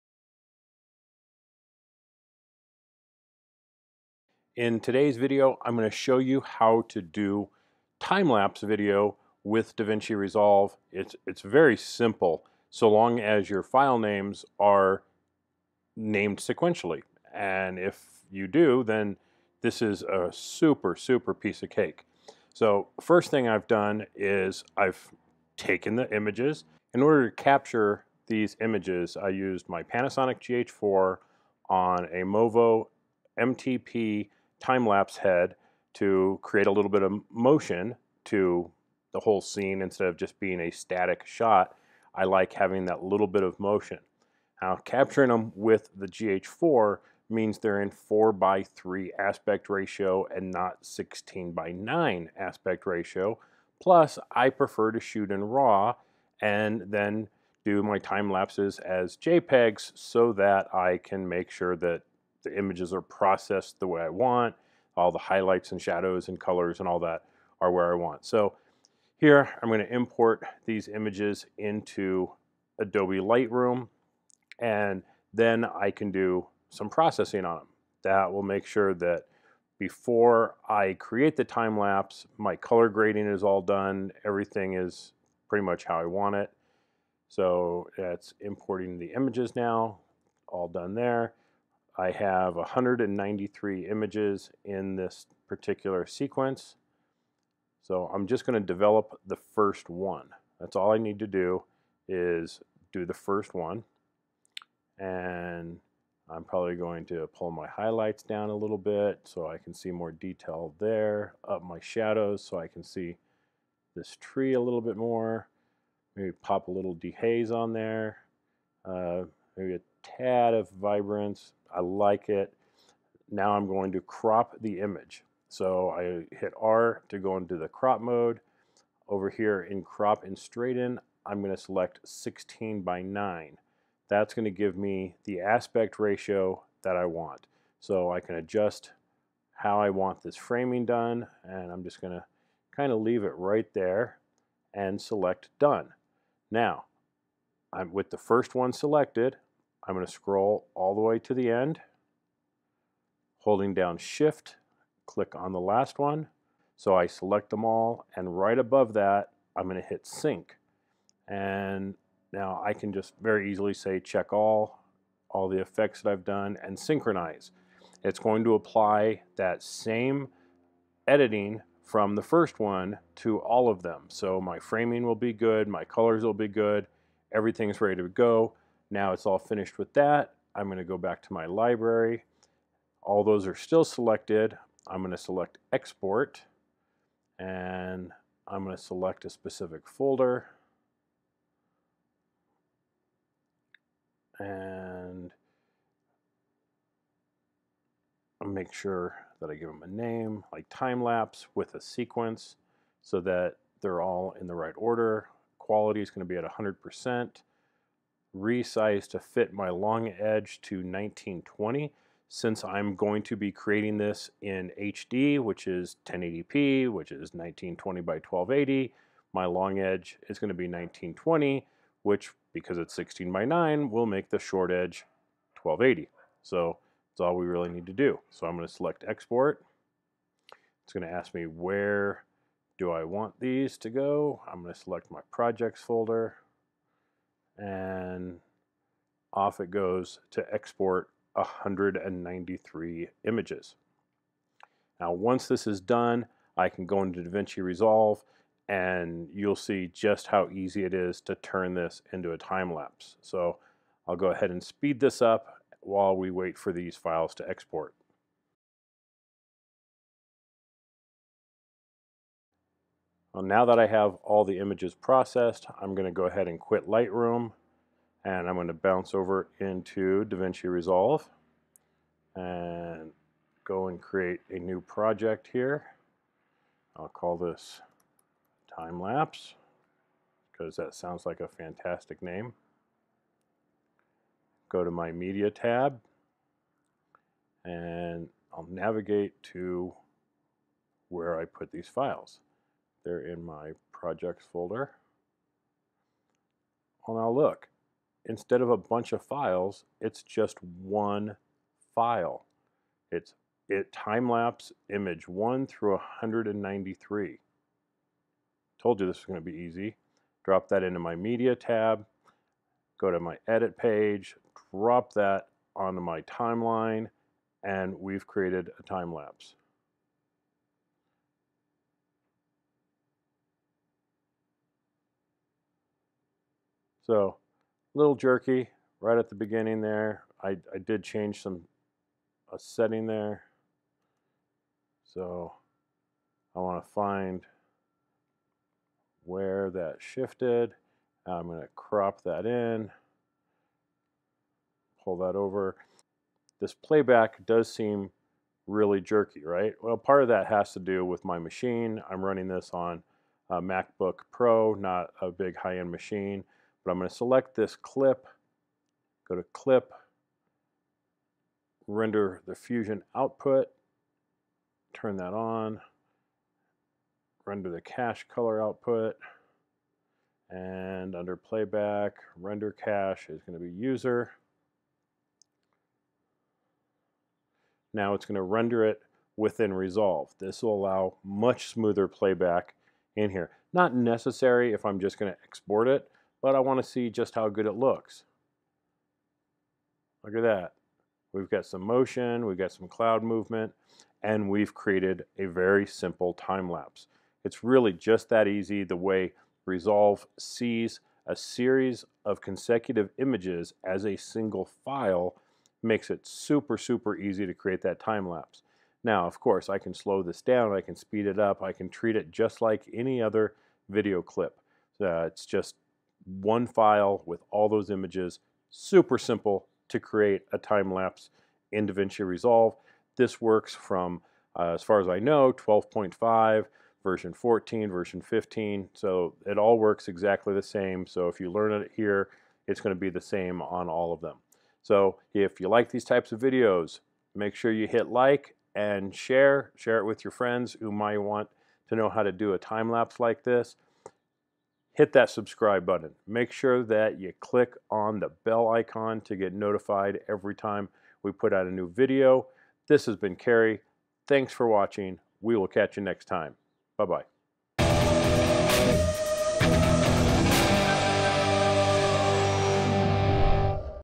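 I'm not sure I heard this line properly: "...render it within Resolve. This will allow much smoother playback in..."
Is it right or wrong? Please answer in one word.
right.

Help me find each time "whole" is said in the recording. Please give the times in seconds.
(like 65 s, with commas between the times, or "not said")
39 s.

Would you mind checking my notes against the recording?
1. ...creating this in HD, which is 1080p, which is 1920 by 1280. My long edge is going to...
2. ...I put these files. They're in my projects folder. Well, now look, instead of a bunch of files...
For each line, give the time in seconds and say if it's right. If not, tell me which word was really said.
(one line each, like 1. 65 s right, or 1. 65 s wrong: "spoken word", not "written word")
1. 213 s right
2. 291 s right.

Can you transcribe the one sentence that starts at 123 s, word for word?
Now I'm going to crop the image.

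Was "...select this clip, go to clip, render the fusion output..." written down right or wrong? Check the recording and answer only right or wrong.
right.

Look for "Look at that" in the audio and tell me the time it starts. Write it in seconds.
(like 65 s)
390 s.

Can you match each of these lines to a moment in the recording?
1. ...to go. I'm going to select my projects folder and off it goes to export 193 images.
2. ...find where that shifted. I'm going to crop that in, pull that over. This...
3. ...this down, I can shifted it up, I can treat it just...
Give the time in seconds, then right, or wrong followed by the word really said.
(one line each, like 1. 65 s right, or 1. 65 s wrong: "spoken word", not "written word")
1. 233 s right
2. 336 s right
3. 410 s wrong: "speed", not "shifted".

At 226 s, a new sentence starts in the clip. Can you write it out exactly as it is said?
So that's all we really need to do.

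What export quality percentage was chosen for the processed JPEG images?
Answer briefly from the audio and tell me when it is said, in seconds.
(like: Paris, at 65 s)
100 percent, at 206 s.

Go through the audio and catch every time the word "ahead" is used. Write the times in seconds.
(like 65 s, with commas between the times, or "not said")
254 s, 266 s.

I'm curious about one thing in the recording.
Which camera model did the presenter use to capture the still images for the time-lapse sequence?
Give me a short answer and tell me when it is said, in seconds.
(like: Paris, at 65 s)
Panasonic GH4, at 29 s.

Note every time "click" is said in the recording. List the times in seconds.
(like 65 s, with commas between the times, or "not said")
155 s, 447 s.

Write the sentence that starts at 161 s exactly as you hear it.
And now I can just very easily say check all, all the effects that I've done and synchronize.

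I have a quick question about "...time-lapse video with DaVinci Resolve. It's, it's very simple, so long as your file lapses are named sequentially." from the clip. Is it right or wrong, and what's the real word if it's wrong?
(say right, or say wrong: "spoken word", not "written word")
wrong: "names", not "lapses".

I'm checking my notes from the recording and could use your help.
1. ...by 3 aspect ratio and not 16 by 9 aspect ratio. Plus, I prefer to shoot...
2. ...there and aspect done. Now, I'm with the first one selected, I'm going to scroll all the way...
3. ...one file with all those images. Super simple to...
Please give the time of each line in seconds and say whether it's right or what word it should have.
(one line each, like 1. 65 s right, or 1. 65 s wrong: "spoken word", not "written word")
1. 48 s right
2. 143 s wrong: "select", not "aspect"
3. 416 s right.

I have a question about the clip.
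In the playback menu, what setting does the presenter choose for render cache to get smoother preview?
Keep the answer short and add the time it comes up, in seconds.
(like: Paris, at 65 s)
User, at 373 s.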